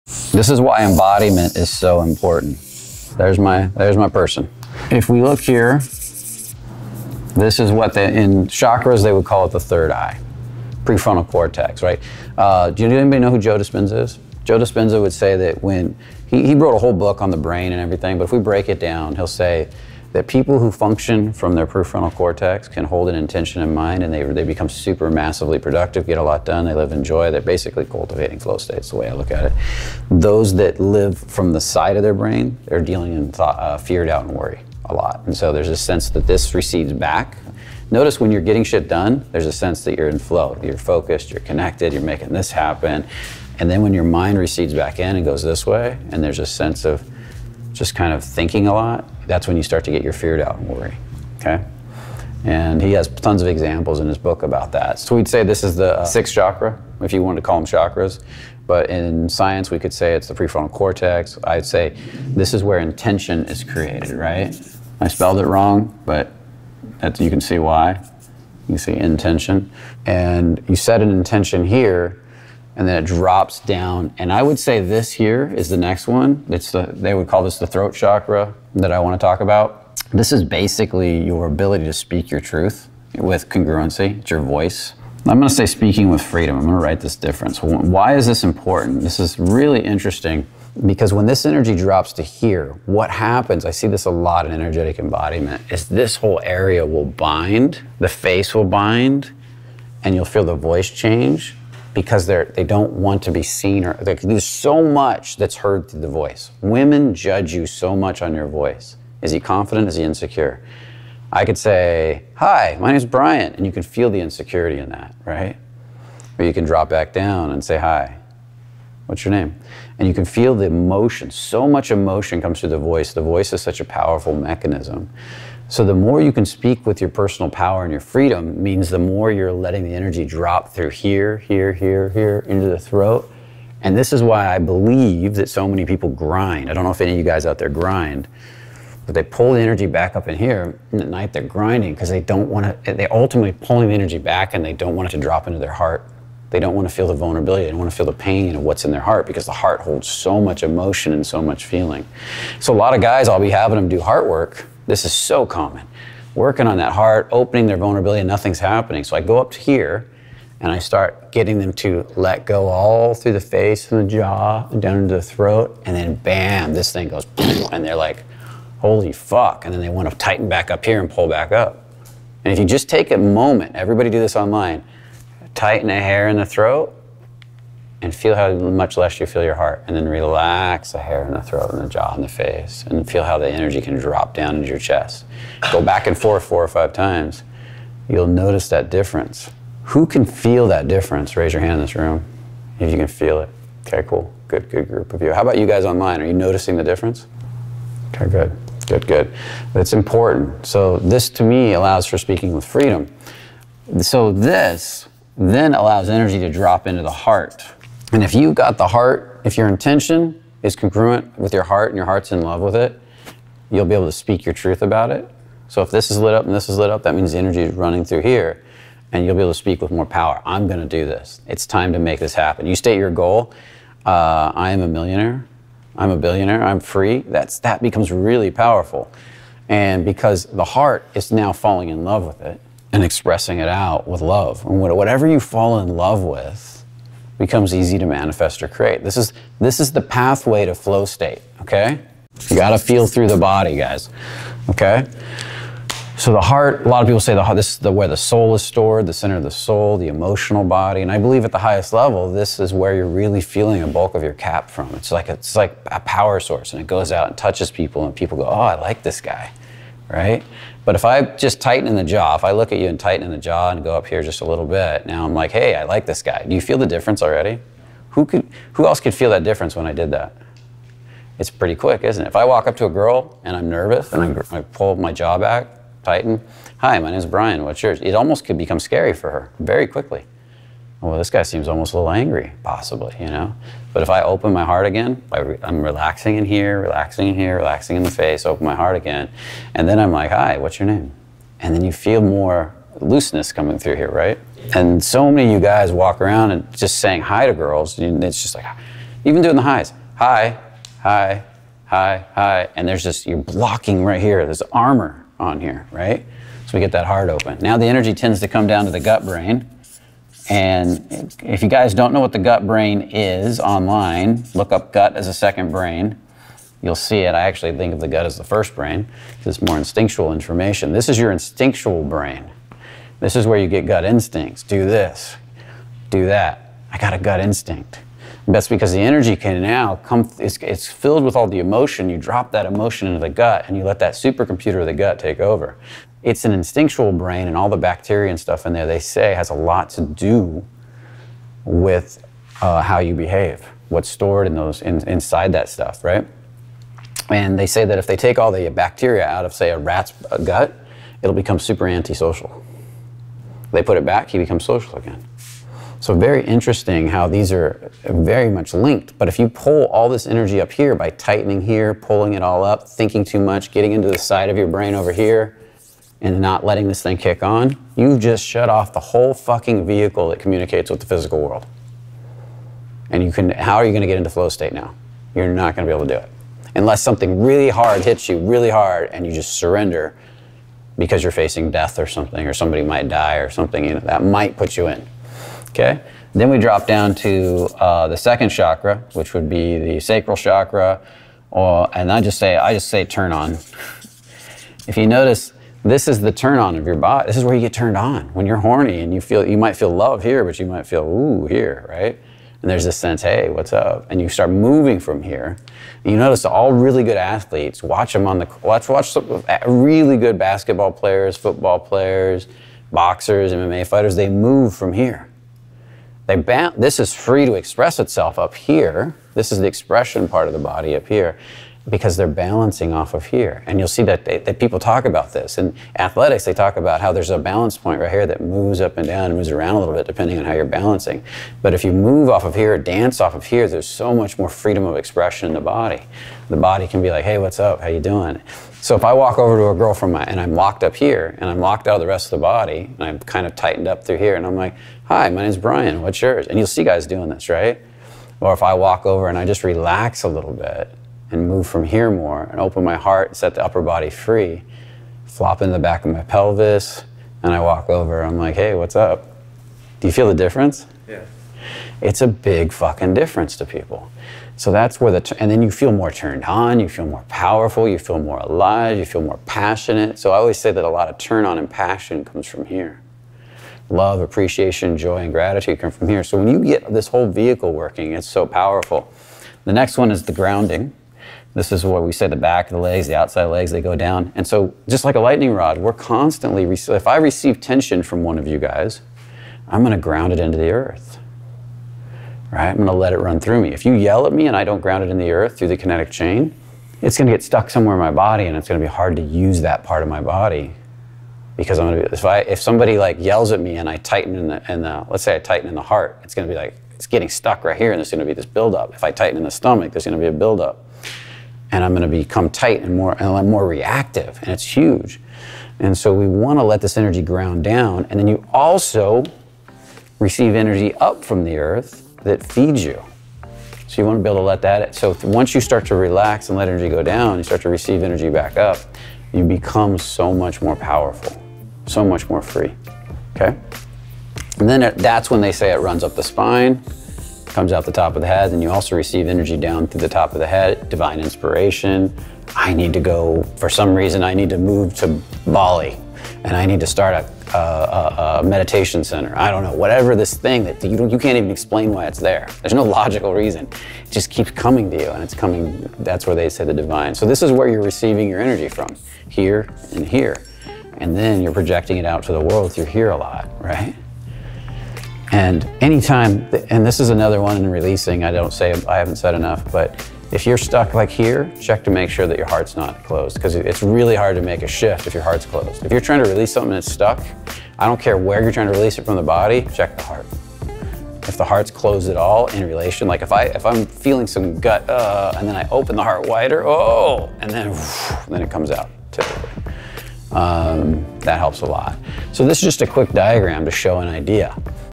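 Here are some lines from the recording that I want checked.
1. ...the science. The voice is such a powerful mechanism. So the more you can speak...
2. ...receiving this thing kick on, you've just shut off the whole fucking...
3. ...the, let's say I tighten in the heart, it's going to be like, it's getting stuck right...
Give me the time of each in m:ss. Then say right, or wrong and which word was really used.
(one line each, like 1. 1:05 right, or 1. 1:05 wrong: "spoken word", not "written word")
1. 2:02 wrong: "voice", not "science"
2. 6:06 wrong: "letting", not "receiving"
3. 8:24 right.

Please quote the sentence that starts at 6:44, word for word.
And you start moving from here.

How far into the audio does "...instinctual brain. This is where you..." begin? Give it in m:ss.
5:21.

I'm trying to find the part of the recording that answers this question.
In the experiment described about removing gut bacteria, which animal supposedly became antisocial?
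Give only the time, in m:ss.
5:49.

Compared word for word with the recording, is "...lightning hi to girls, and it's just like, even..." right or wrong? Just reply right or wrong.
wrong.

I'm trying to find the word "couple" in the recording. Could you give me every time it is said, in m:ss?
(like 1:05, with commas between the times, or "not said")
not said.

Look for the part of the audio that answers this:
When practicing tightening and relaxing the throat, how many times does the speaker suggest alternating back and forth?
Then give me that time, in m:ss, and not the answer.
3:06.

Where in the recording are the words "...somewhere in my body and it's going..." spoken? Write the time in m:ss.
8:17.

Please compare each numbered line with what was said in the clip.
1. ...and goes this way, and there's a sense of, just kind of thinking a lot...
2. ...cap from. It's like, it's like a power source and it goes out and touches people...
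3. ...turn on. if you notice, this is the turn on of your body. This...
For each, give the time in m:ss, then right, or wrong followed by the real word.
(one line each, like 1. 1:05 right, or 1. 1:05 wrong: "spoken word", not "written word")
1. 0:45 right
2. 4:14 right
3. 6:33 right.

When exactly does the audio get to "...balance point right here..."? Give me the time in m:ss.
7:07.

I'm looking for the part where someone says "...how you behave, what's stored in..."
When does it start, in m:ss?
5:42.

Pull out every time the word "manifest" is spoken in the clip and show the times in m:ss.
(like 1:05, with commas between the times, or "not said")
3:58.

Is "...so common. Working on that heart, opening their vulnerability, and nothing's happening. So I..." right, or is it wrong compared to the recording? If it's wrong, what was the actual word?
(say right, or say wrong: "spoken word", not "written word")
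right.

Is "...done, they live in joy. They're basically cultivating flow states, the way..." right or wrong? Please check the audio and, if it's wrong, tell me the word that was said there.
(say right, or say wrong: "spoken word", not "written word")
right.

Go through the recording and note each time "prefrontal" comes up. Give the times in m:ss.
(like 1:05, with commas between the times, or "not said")
0:10, 0:21, 1:00.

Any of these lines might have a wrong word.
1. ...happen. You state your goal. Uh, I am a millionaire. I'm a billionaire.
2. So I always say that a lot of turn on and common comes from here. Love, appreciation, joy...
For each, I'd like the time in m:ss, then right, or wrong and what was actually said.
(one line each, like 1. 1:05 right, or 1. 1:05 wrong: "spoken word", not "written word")
1. 3:42 right
2. 7:50 wrong: "passion", not "common".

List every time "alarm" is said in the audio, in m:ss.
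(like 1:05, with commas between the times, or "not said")
not said.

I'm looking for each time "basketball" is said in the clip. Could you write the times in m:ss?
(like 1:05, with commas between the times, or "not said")
6:50.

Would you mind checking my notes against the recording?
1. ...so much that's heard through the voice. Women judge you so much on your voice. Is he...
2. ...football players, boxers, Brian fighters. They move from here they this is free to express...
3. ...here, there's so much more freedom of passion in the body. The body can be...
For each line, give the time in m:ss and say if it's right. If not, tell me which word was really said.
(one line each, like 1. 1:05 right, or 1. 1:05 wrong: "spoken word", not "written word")
1. 1:44 right
2. 6:51 wrong: "MMA", not "Brian"
3. 7:13 wrong: "expression", not "passion".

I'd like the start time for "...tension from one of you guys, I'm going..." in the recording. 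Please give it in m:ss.
8:07.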